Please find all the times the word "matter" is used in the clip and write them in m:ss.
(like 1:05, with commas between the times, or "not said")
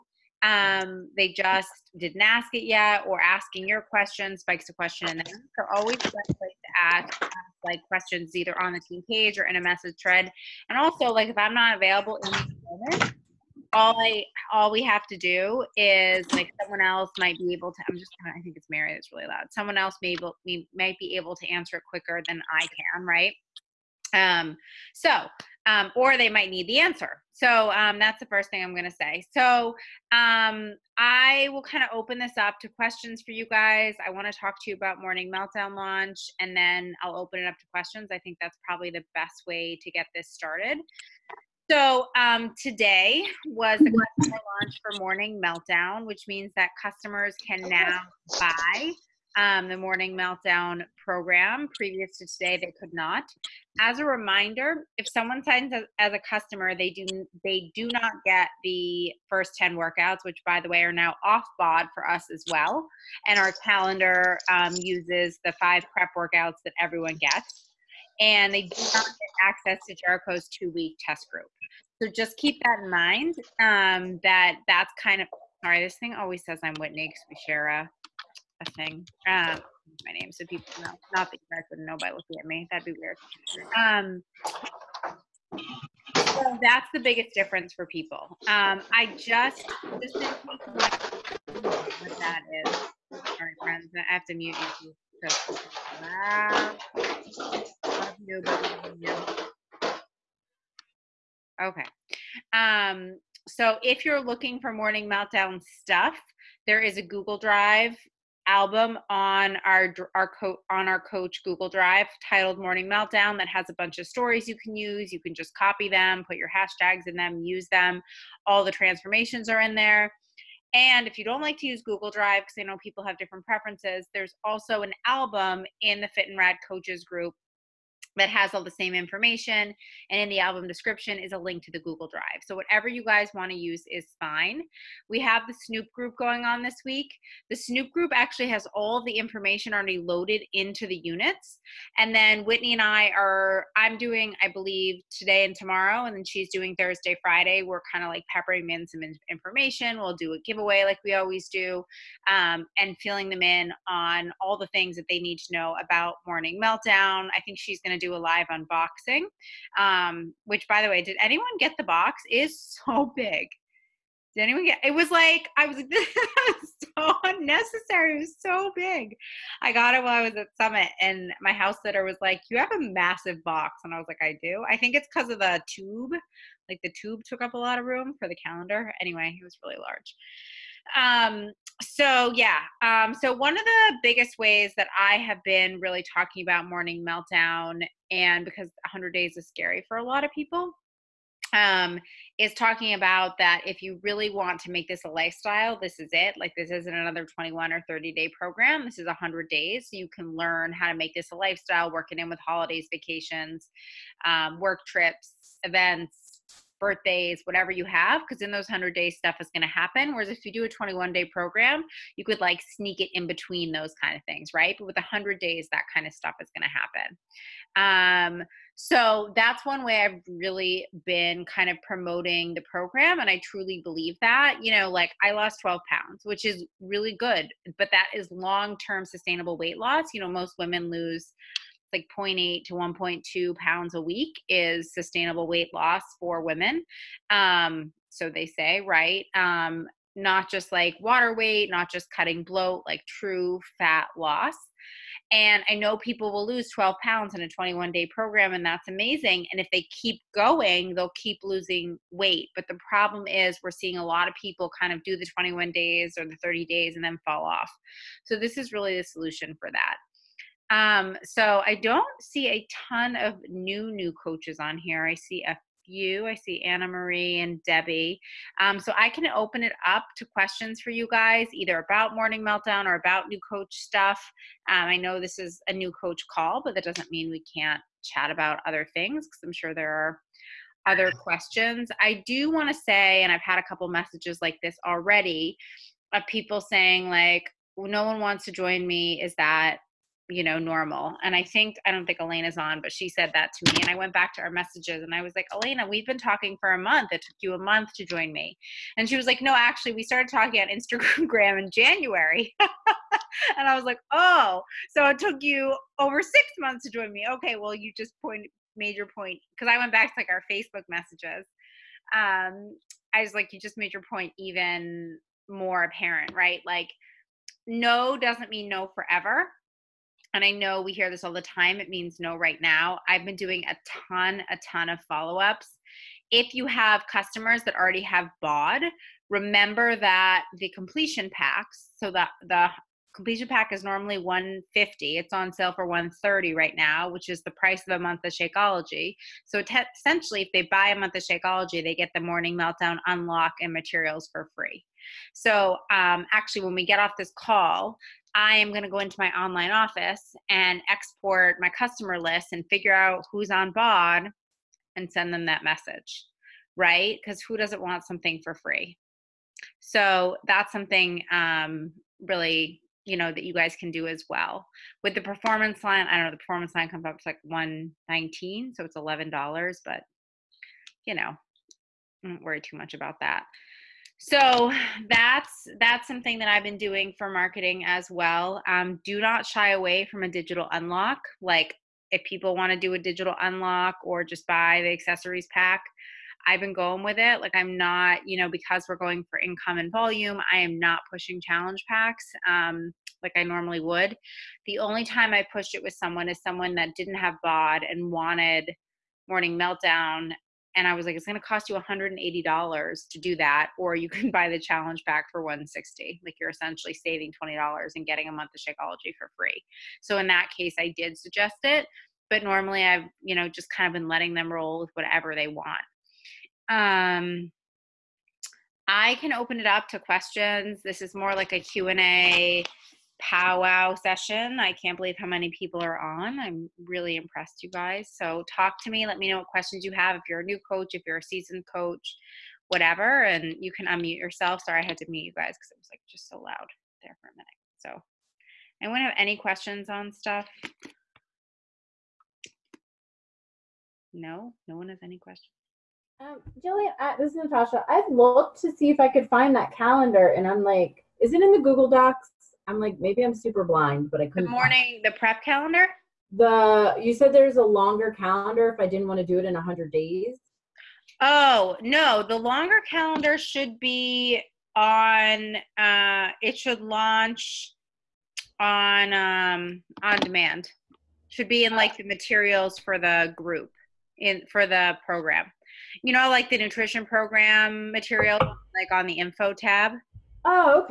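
not said.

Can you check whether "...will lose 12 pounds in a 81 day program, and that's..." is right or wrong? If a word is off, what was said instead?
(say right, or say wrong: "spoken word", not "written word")
wrong: "21", not "81".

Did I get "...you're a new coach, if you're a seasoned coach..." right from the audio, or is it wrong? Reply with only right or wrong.
right.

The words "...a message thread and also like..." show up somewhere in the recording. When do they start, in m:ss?
0:09.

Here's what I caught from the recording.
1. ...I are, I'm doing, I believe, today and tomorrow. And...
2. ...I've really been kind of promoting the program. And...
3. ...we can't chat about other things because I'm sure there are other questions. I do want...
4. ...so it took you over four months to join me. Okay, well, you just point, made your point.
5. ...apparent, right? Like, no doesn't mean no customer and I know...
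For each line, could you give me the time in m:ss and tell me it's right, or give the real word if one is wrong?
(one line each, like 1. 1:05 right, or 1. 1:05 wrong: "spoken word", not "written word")
1. 2:22 right
2. 3:40 right
3. 4:37 right
4. 5:04 wrong: "six", not "four"
5. 5:15 wrong: "forever", not "customer".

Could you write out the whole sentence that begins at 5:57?
Because who doesn't want something for free?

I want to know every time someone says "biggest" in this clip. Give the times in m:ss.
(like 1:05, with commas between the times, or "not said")
1:26, 3:04.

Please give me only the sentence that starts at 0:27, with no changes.
So um, that's the first thing I'm going to say.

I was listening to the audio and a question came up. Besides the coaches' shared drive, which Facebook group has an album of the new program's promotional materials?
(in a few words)
Fit and Rad Coaches.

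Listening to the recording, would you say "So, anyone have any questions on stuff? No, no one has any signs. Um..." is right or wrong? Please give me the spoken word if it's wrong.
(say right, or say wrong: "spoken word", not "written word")
wrong: "questions", not "signs".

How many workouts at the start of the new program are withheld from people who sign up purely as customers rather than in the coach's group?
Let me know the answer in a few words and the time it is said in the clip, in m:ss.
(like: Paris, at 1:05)
10, at 0:59.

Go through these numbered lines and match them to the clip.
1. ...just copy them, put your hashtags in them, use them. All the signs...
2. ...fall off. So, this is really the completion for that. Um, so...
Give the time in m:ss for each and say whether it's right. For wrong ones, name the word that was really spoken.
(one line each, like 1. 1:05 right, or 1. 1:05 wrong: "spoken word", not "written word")
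1. 1:55 wrong: "transformations", not "signs"
2. 4:17 wrong: "solution", not "completion".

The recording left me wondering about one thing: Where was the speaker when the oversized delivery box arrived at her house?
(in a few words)
Summit.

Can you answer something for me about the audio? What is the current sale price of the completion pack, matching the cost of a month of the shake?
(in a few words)
$130.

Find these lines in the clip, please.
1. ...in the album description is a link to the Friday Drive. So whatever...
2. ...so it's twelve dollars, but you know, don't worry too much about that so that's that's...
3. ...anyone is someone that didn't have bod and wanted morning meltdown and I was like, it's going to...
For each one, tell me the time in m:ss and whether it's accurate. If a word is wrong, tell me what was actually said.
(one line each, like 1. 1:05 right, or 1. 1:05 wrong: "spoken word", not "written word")
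1. 2:10 wrong: "Google", not "Friday"
2. 6:08 wrong: "eleven", not "twelve"
3. 6:35 wrong: "someone", not "anyone".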